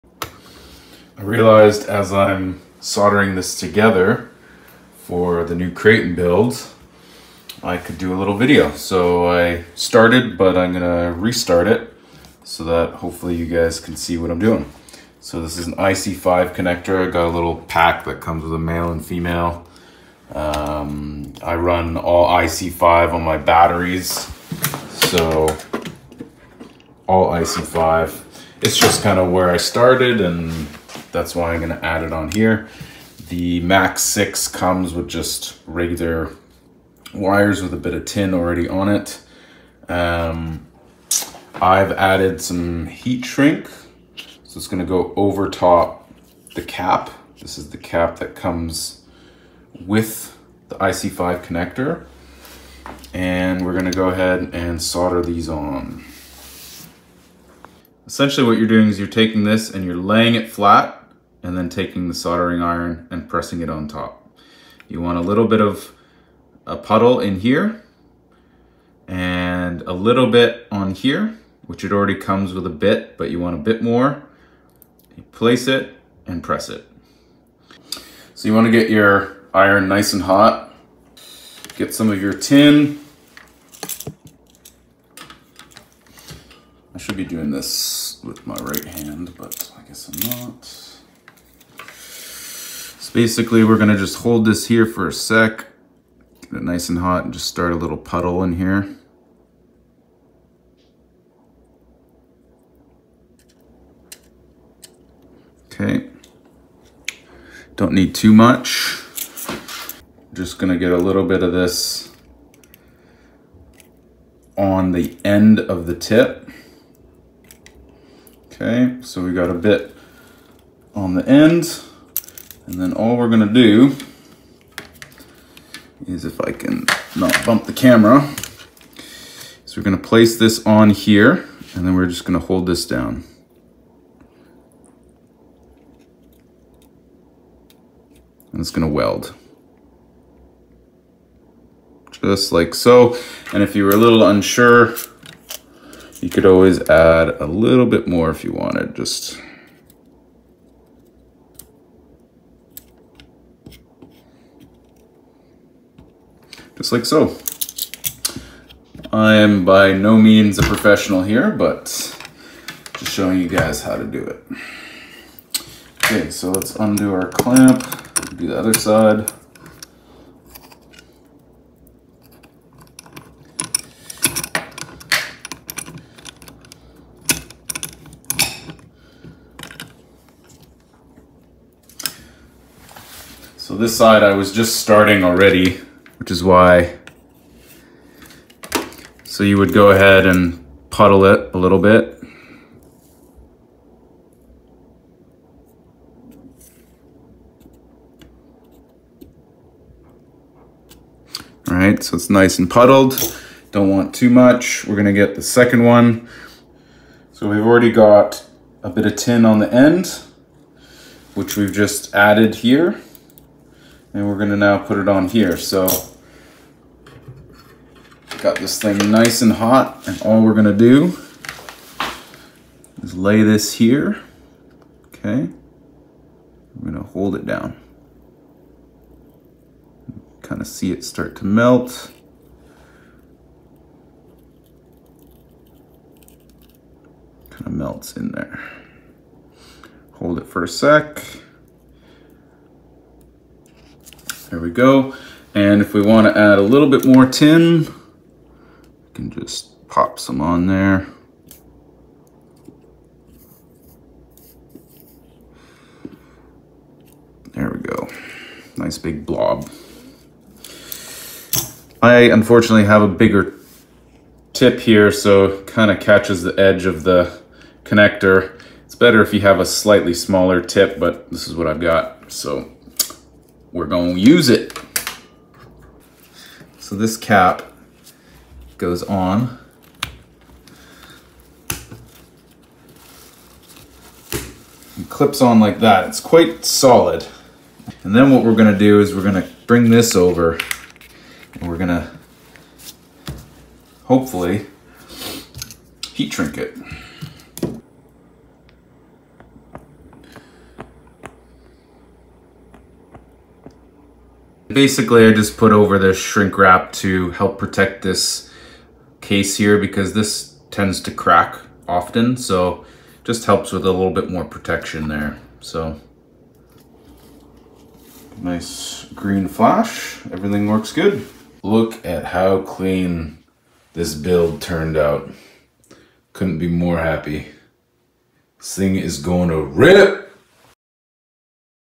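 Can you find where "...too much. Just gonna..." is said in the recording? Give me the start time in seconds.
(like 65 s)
108 s.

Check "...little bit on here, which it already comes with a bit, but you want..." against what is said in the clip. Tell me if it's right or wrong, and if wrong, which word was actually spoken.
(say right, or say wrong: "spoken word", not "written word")
right.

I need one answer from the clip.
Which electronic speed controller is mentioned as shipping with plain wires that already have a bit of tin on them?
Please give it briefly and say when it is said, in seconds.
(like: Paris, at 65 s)
Max 6, at 33 s.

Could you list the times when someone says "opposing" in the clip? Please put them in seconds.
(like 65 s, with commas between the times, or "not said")
not said.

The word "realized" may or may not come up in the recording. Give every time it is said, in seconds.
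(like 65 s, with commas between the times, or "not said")
1 s.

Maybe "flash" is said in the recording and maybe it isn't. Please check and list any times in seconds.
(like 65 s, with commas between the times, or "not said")
319 s.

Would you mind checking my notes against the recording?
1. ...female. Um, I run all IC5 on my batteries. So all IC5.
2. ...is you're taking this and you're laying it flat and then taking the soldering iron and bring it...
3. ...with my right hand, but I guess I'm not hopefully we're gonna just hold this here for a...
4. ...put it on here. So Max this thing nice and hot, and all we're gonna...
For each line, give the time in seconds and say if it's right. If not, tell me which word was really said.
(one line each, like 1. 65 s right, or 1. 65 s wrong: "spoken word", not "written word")
1. 19 s right
2. 58 s wrong: "pressing", not "bring"
3. 88 s wrong: "basically", not "hopefully"
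4. 214 s wrong: "Got", not "Max".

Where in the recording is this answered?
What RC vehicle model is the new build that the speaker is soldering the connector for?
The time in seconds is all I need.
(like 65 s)
5 s.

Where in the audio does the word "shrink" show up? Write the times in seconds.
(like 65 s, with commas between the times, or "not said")
43 s, 296 s, 306 s.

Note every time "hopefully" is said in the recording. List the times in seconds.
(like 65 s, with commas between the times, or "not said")
12 s, 294 s.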